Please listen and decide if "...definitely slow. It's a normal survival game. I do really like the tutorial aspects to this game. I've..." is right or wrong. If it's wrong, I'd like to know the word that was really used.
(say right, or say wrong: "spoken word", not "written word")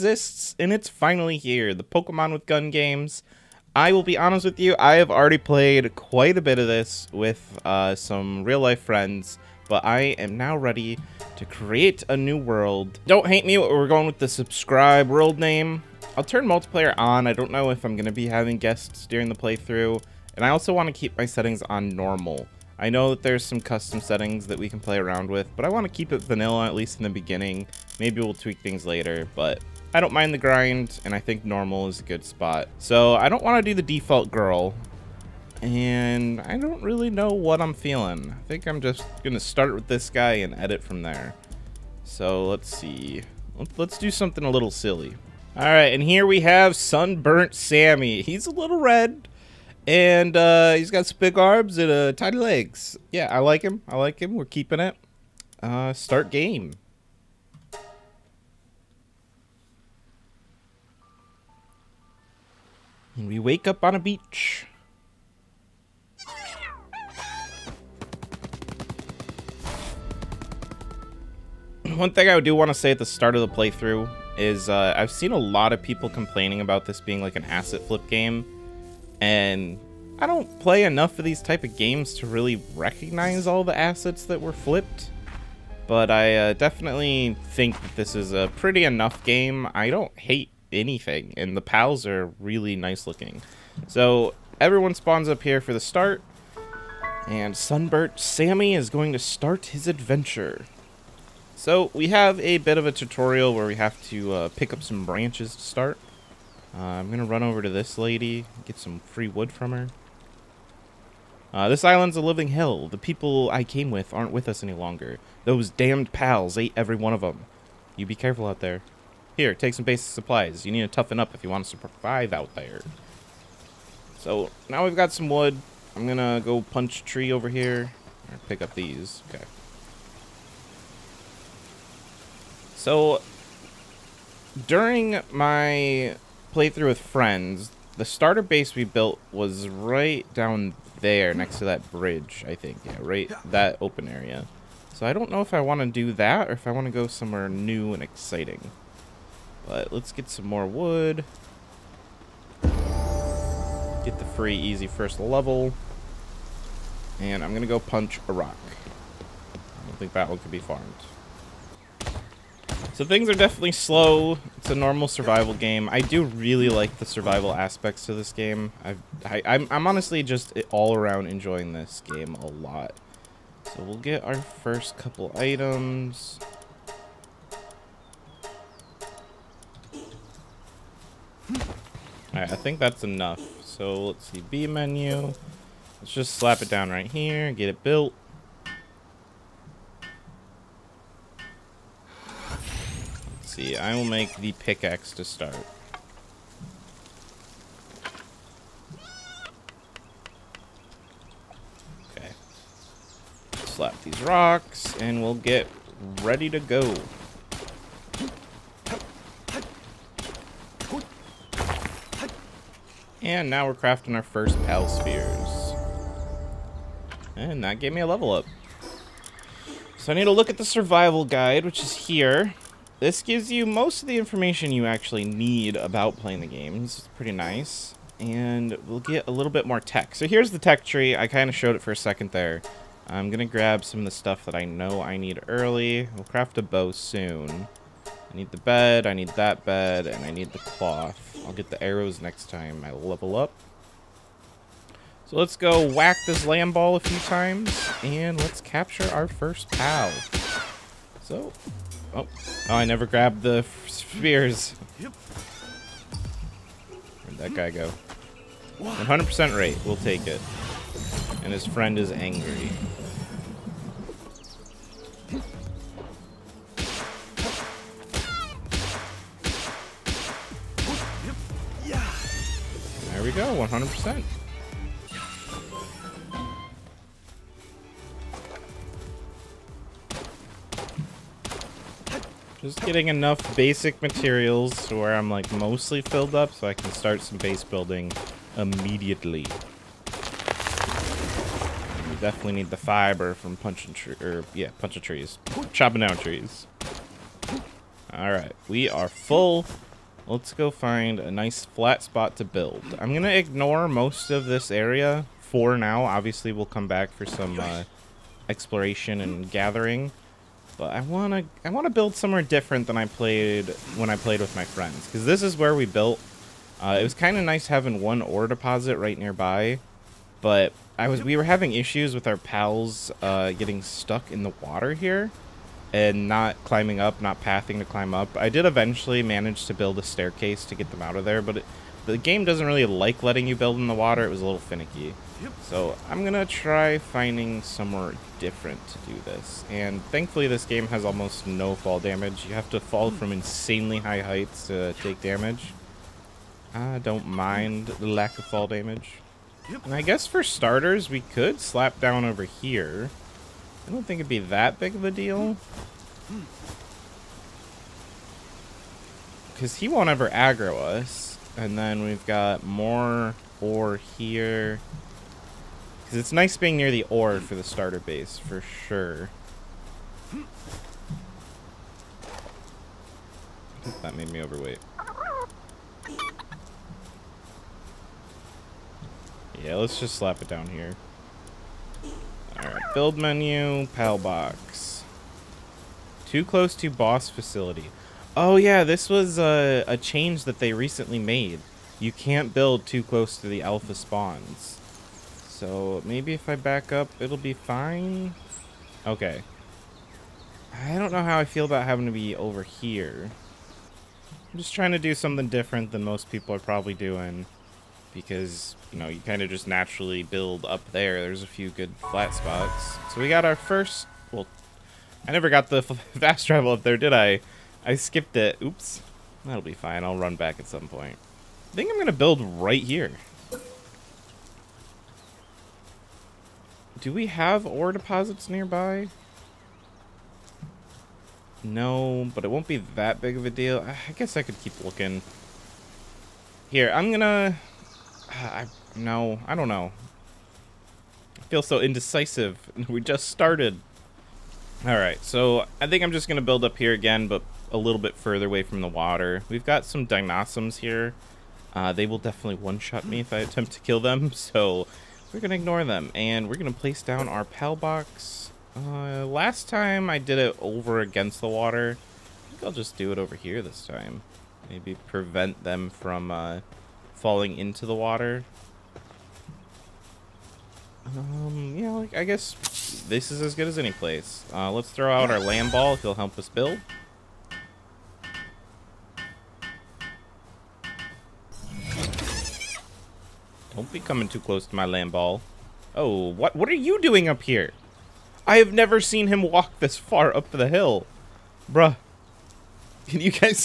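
wrong: "survival", not "tutorial".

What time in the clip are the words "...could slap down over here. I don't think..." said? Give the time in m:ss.
5:51.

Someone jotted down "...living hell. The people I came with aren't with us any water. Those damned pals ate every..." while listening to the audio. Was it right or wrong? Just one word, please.
wrong.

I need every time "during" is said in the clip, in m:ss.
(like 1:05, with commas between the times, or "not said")
0:19, 2:14.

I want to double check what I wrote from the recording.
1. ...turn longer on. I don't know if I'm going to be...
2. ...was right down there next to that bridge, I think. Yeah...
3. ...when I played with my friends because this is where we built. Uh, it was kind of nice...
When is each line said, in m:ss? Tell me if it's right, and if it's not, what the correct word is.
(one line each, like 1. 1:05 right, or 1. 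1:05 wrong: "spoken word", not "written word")
1. 0:16 wrong: "multiplayer", not "longer"
2. 2:19 right
3. 5:13 right.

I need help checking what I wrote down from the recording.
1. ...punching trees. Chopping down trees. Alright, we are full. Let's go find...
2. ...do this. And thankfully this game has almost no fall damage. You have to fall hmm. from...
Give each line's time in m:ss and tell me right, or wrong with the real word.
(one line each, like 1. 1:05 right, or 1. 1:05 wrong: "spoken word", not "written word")
1. 4:54 right
2. 5:38 right.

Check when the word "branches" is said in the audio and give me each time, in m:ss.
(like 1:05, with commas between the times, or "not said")
1:45.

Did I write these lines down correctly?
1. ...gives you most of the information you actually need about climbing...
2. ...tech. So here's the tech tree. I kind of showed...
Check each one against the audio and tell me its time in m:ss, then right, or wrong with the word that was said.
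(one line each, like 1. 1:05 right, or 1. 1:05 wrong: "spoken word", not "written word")
1. 3:43 wrong: "playing", not "climbing"
2. 3:49 right.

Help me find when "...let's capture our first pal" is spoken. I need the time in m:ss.
4:08.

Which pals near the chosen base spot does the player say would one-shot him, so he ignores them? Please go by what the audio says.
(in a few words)
Dinossoms.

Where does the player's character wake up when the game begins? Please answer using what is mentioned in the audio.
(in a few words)
On a beach.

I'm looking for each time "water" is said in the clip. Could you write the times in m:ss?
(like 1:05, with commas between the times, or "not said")
5:24, 5:33, 7:28, 7:41, 7:47.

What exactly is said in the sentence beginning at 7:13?
I guess I could keep looking.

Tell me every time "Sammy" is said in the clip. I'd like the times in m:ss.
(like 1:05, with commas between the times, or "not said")
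0:47, 1:38.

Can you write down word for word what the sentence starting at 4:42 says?
Just getting enough basic materials to where I'm like mostly filled up so I can start some base building immediately.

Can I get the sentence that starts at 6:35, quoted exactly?
So maybe if I back up, it'll be fine.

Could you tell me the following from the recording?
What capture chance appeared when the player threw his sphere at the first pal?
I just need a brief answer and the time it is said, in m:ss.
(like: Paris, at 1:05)
100%, at 4:18.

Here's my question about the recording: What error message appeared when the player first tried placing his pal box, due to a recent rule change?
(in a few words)
Too close to boss facility.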